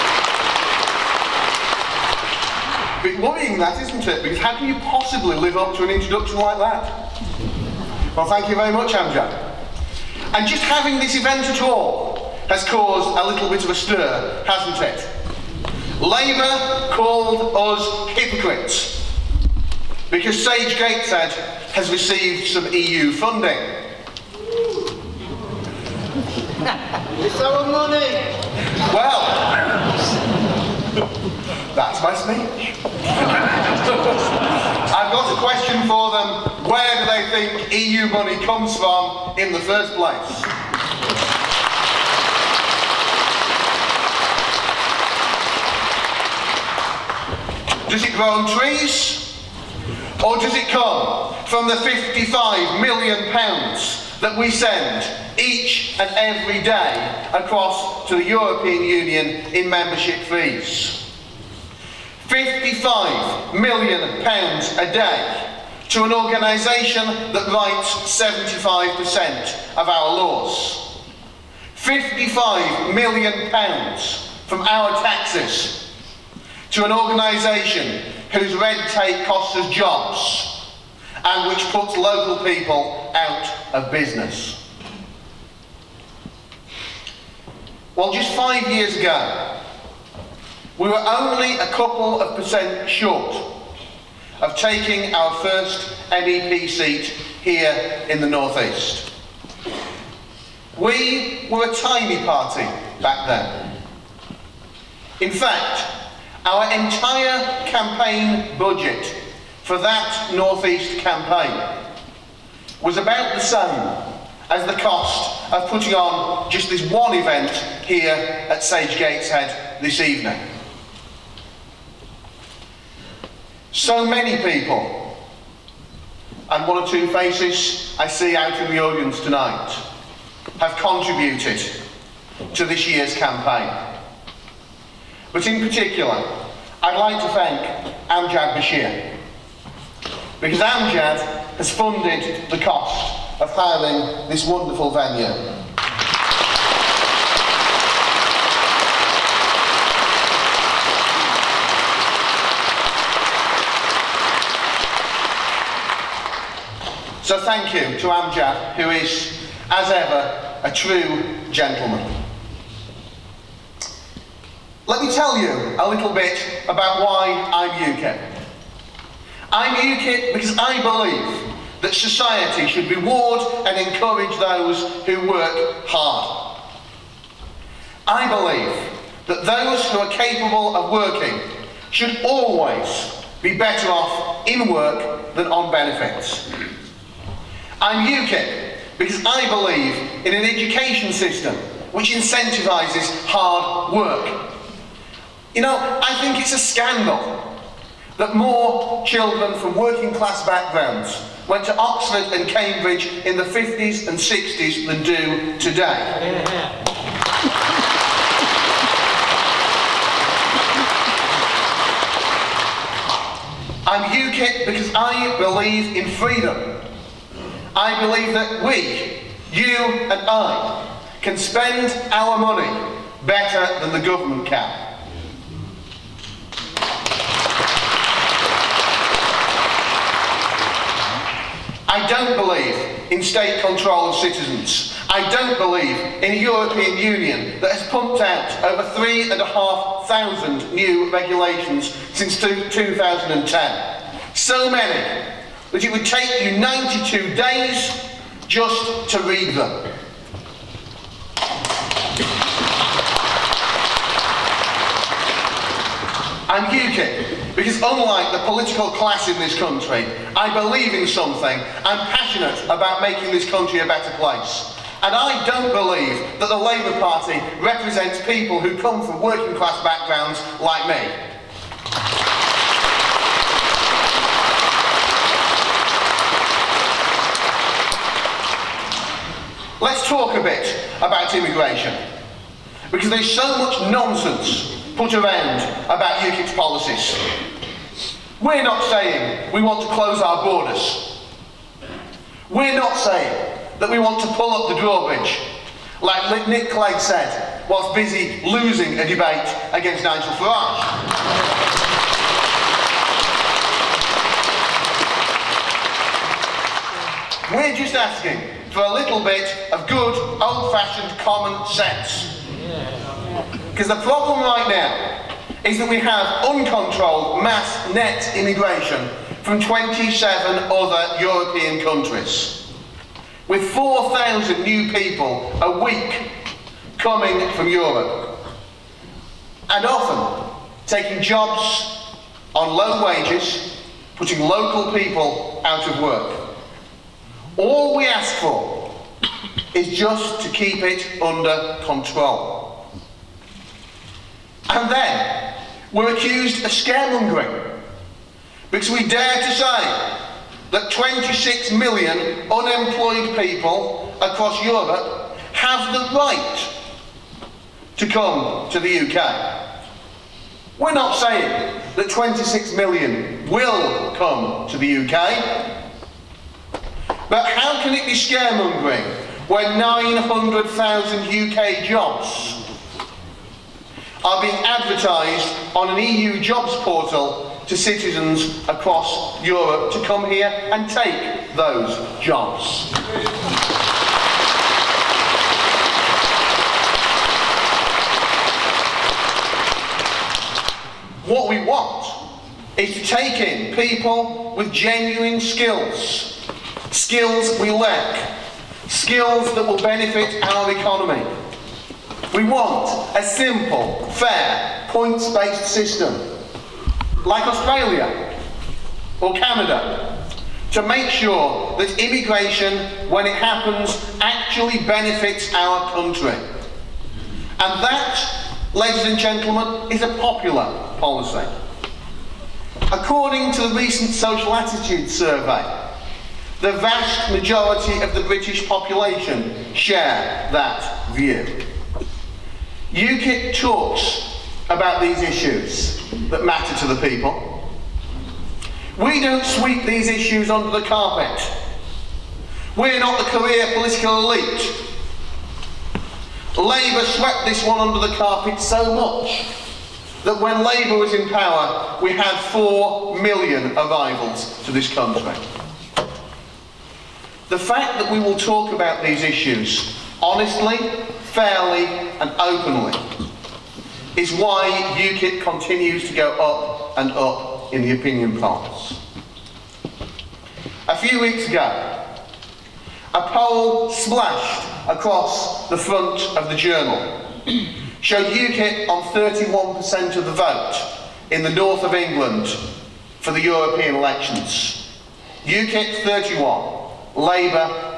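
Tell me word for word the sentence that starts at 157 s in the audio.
So thank you to Amjad, who is, as ever, a true gentleman.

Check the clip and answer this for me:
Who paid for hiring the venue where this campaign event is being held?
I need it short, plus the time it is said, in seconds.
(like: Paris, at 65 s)
Amjad Bashir, at 138 s.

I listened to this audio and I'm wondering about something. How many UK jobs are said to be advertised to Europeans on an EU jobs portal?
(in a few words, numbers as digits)
900,000.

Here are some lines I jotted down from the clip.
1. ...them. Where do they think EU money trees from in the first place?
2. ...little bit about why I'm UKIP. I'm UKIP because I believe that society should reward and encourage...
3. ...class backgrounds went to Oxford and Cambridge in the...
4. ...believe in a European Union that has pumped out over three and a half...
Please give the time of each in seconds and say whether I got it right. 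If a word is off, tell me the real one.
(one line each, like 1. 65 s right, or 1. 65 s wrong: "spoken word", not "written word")
1. 36 s wrong: "comes", not "trees"
2. 165 s right
3. 200 s right
4. 235 s right.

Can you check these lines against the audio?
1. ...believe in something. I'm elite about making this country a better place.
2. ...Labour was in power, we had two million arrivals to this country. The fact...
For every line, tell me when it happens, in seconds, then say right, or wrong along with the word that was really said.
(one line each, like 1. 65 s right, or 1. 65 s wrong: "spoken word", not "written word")
1. 260 s wrong: "passionate", not "elite"
2. 450 s wrong: "four", not "two".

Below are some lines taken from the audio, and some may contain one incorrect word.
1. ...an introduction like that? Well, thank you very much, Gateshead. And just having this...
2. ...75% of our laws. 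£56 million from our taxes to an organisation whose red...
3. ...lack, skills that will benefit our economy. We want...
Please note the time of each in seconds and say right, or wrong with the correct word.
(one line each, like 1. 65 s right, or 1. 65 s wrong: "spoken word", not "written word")
1. 5 s wrong: "Amjad", not "Gateshead"
2. 68 s wrong: "55", not "56"
3. 397 s right.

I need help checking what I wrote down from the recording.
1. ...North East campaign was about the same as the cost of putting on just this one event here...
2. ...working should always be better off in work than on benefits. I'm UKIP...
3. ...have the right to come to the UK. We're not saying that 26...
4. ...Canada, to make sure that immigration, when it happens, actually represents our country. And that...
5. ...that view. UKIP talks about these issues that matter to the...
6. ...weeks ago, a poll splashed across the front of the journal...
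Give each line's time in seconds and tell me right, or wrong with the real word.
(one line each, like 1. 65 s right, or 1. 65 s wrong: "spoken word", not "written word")
1. 110 s right
2. 180 s right
3. 355 s right
4. 409 s wrong: "benefits", not "represents"
5. 430 s right
6. 471 s right.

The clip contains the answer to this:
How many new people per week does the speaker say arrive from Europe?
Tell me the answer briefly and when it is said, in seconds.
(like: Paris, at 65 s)
4,000, at 323 s.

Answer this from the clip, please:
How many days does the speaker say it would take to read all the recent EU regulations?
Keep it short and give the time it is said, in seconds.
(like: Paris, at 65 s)
92, at 246 s.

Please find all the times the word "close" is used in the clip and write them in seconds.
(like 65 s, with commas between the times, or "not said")
289 s.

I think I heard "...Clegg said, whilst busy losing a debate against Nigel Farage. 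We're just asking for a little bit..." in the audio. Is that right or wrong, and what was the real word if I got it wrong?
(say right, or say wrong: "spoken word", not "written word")
right.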